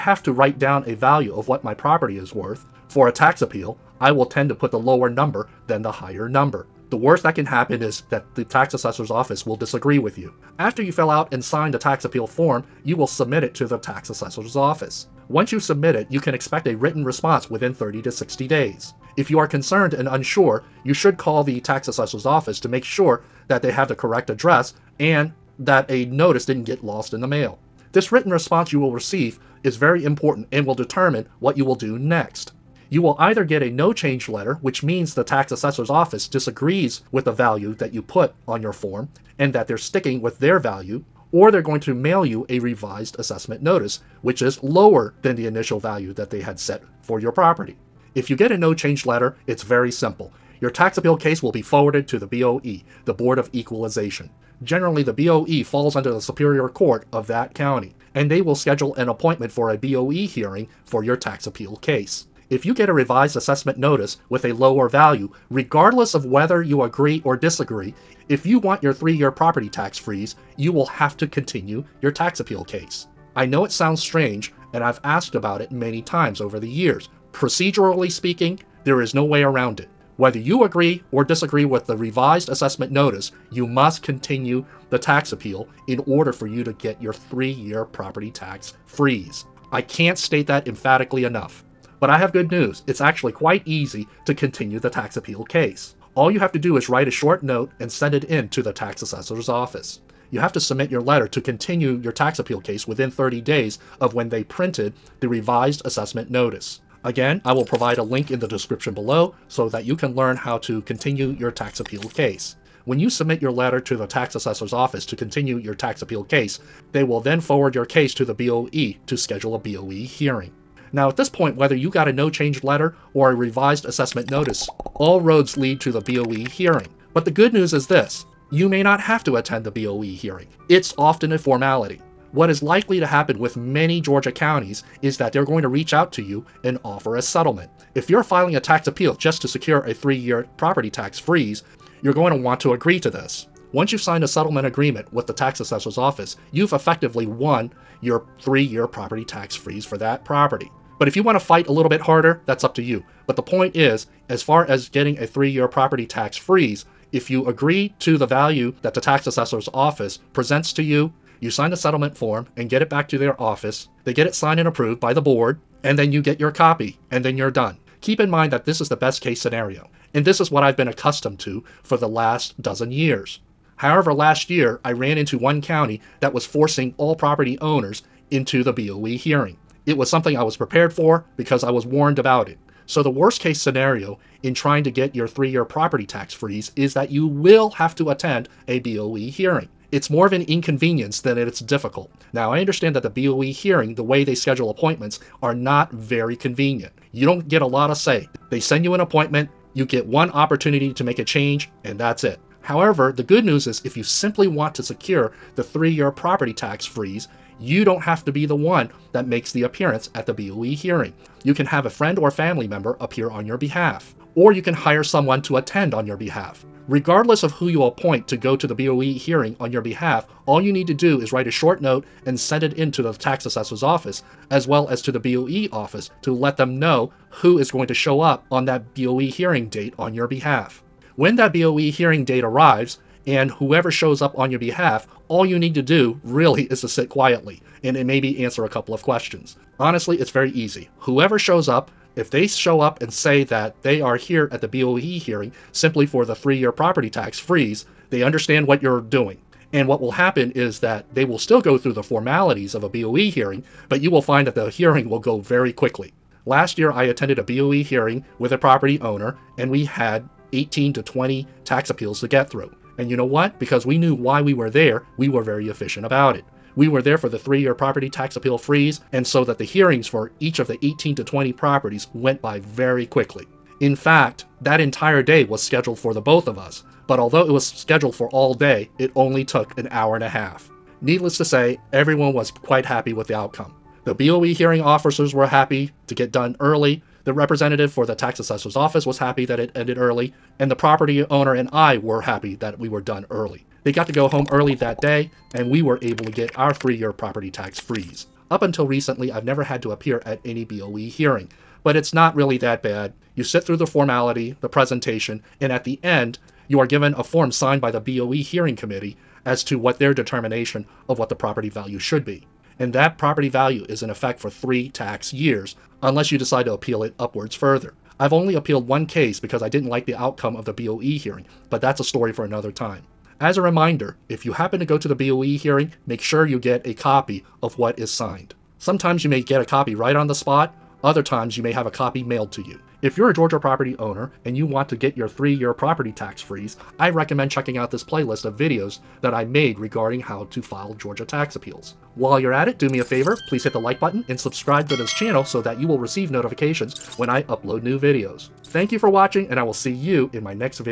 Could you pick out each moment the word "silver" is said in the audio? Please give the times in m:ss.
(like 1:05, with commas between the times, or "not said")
not said.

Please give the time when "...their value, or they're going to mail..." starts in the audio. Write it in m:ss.
0:40.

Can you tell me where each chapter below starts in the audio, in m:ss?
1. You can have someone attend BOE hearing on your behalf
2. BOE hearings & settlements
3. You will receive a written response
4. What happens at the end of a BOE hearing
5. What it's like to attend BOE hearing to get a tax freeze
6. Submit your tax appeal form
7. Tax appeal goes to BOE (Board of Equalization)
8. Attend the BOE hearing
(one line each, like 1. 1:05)
1. 3:22
2. 2:00
3. 0:27
4. 5:05
5. 4:16
6. 0:10
7. 0:49
8. 3:02.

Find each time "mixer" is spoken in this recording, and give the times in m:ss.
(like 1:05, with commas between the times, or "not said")
not said.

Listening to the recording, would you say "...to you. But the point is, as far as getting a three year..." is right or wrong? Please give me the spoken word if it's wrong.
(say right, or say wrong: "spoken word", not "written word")
right.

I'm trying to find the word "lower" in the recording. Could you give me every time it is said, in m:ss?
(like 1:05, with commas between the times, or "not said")
0:04, 0:44, 1:04.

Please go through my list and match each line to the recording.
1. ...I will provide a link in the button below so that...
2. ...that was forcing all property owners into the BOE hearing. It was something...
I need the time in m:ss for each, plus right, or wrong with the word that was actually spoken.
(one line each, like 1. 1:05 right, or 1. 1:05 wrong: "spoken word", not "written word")
1. 1:47 wrong: "description", not "button"
2. 2:56 right.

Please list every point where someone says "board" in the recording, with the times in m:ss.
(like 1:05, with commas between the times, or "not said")
0:53, 2:45.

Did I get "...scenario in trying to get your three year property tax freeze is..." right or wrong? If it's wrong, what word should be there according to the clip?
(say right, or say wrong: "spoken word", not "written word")
right.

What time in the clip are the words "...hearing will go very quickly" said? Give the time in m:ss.
4:14.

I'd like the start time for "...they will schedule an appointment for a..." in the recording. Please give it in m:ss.
0:58.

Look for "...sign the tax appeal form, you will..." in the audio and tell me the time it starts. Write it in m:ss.
0:11.